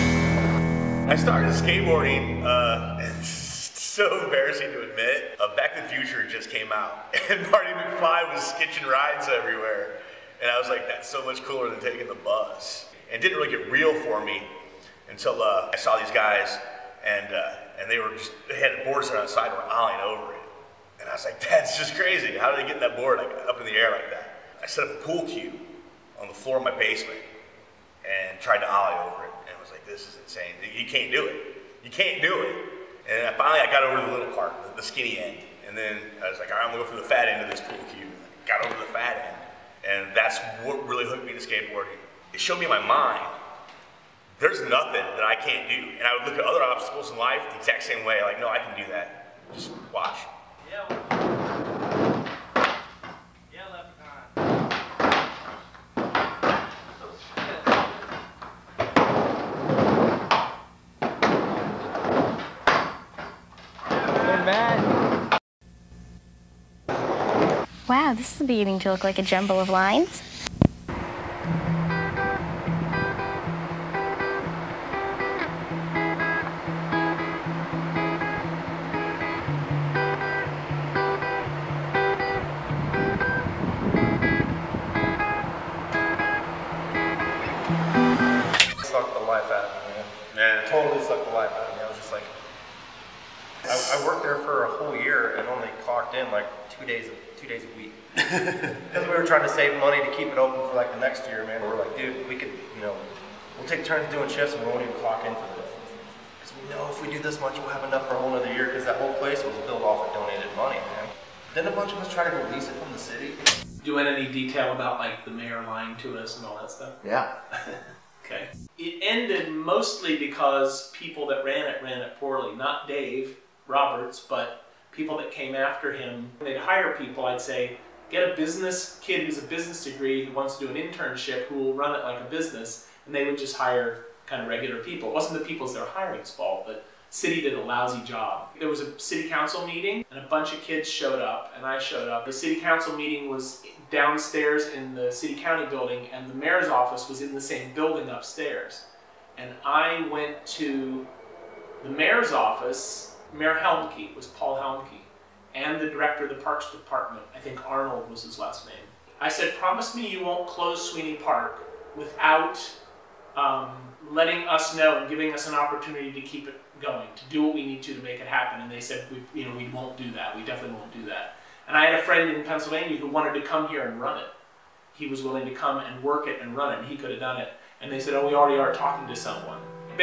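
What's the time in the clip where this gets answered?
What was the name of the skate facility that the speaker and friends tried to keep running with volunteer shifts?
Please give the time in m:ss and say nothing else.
2:40.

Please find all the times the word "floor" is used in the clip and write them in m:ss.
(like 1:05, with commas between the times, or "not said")
0:26.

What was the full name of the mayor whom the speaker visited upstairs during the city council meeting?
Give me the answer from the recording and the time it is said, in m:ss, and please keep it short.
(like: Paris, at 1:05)
Paul Helmke, at 2:34.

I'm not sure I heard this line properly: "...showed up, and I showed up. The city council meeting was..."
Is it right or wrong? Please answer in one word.
right.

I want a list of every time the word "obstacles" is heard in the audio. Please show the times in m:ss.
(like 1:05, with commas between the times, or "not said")
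0:46.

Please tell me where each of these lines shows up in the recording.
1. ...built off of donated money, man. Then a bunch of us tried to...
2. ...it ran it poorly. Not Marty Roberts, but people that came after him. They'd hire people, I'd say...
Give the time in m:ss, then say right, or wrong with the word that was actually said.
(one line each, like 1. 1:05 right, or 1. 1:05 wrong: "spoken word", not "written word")
1. 1:49 right
2. 2:01 wrong: "Dave", not "Marty".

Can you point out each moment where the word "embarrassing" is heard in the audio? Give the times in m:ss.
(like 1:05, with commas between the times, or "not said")
0:04.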